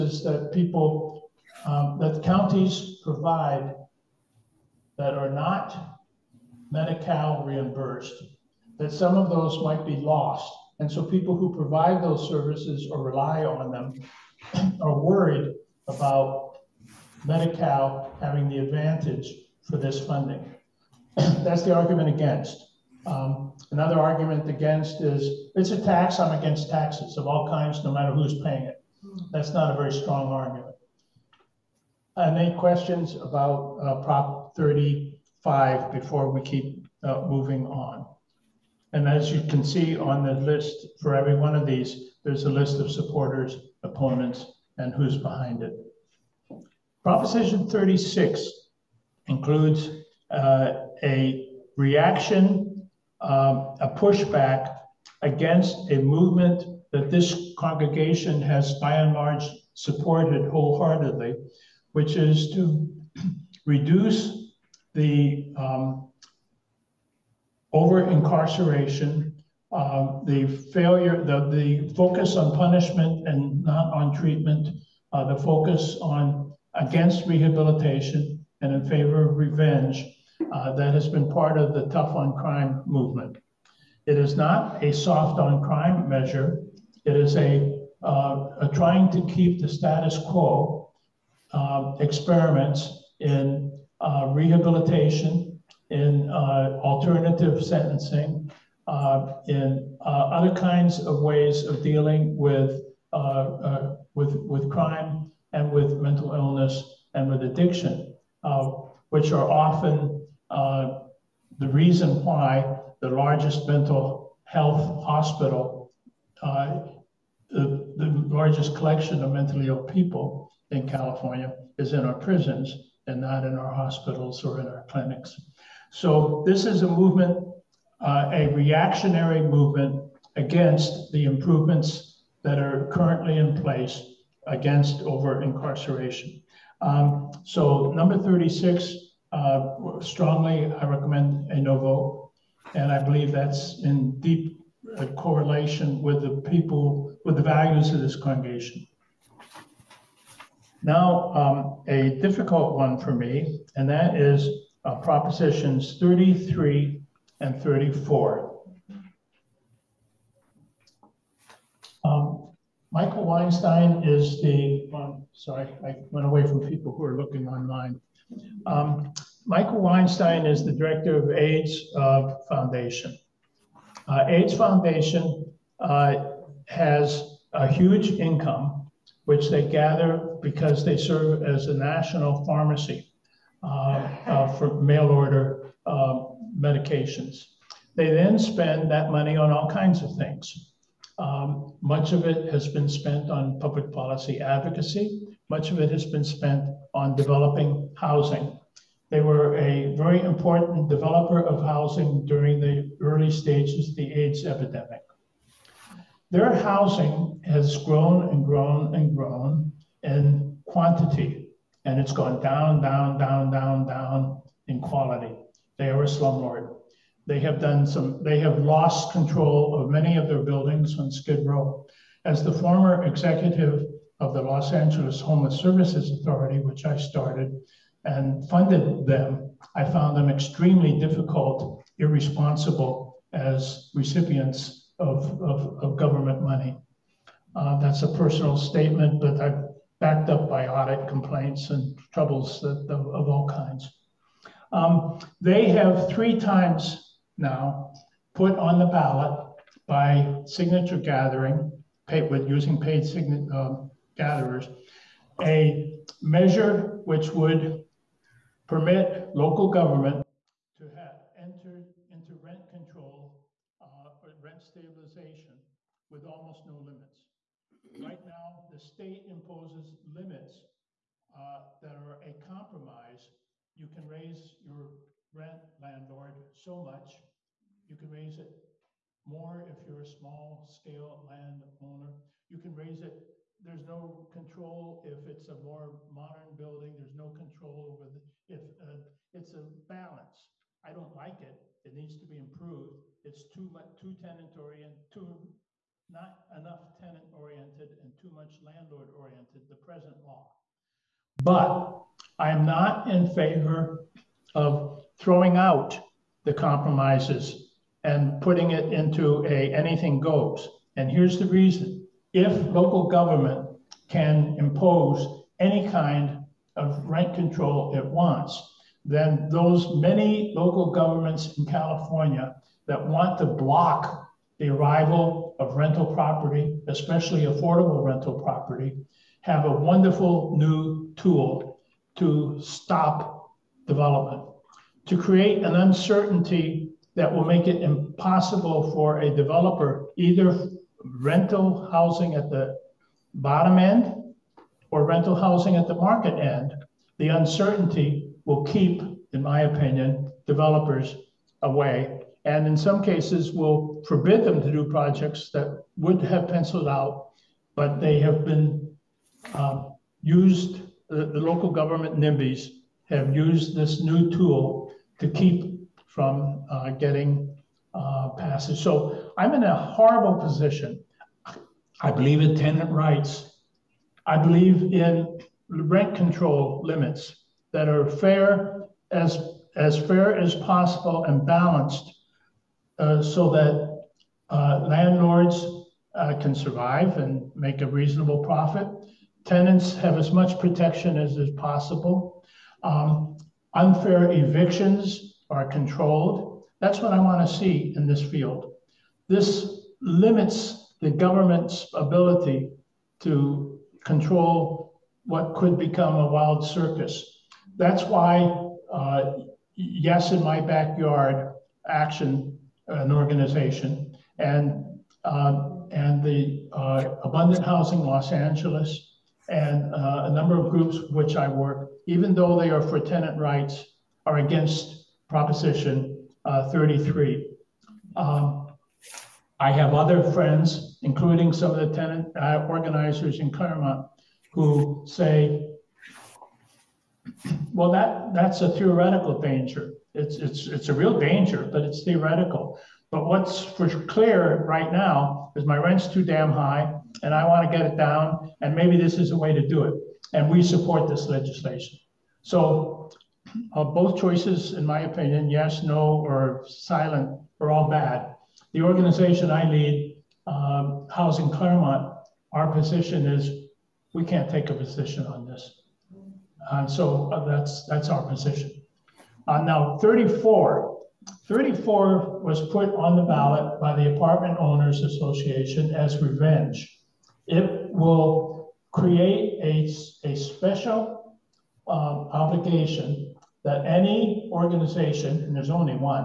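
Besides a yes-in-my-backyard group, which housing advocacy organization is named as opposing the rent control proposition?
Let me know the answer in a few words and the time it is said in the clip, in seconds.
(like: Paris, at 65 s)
Abundant Housing Los Angeles, at 417 s.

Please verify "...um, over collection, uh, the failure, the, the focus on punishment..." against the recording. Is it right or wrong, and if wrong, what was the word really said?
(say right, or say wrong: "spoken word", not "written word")
wrong: "incarceration", not "collection".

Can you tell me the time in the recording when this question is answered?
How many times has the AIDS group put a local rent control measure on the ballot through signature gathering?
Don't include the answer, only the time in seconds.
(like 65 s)
246 s.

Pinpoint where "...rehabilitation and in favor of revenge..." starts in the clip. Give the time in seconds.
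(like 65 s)
77 s.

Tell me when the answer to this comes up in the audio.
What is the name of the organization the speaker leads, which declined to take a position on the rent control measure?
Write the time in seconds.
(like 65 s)
461 s.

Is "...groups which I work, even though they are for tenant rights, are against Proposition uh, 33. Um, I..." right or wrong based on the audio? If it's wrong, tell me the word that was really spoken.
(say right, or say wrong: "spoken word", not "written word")
right.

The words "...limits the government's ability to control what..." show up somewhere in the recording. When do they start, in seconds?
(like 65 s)
400 s.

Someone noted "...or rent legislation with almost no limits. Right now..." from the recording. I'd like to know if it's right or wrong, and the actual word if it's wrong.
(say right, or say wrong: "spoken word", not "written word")
wrong: "stabilization", not "legislation".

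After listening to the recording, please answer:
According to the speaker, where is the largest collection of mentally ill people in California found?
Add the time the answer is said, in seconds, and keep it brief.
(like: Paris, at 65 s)
Prisons, at 122 s.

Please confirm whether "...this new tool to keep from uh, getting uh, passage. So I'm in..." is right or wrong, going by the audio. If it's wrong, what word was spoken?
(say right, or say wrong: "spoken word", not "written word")
right.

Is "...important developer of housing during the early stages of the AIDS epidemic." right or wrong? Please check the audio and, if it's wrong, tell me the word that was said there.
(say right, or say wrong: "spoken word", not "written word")
right.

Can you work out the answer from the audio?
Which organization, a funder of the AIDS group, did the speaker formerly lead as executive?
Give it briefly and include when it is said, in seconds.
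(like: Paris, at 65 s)
Los Angeles Homeless Services Authority, at 224 s.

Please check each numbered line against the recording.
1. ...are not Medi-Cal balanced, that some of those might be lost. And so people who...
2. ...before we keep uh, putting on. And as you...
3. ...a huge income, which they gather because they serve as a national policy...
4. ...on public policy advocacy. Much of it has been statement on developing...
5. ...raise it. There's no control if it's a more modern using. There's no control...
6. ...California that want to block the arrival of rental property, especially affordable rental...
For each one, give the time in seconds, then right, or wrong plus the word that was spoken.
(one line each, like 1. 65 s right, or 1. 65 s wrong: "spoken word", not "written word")
1. 5 s wrong: "reimbursed", not "balanced"
2. 35 s wrong: "moving", not "putting"
3. 177 s wrong: "pharmacy", not "policy"
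4. 193 s wrong: "spent", not "statement"
5. 282 s wrong: "building", not "using"
6. 321 s right.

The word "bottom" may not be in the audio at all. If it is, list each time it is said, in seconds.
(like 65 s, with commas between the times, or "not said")
343 s.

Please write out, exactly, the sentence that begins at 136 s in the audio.
Um, so number 36, uh, strongly I recommend a no vote.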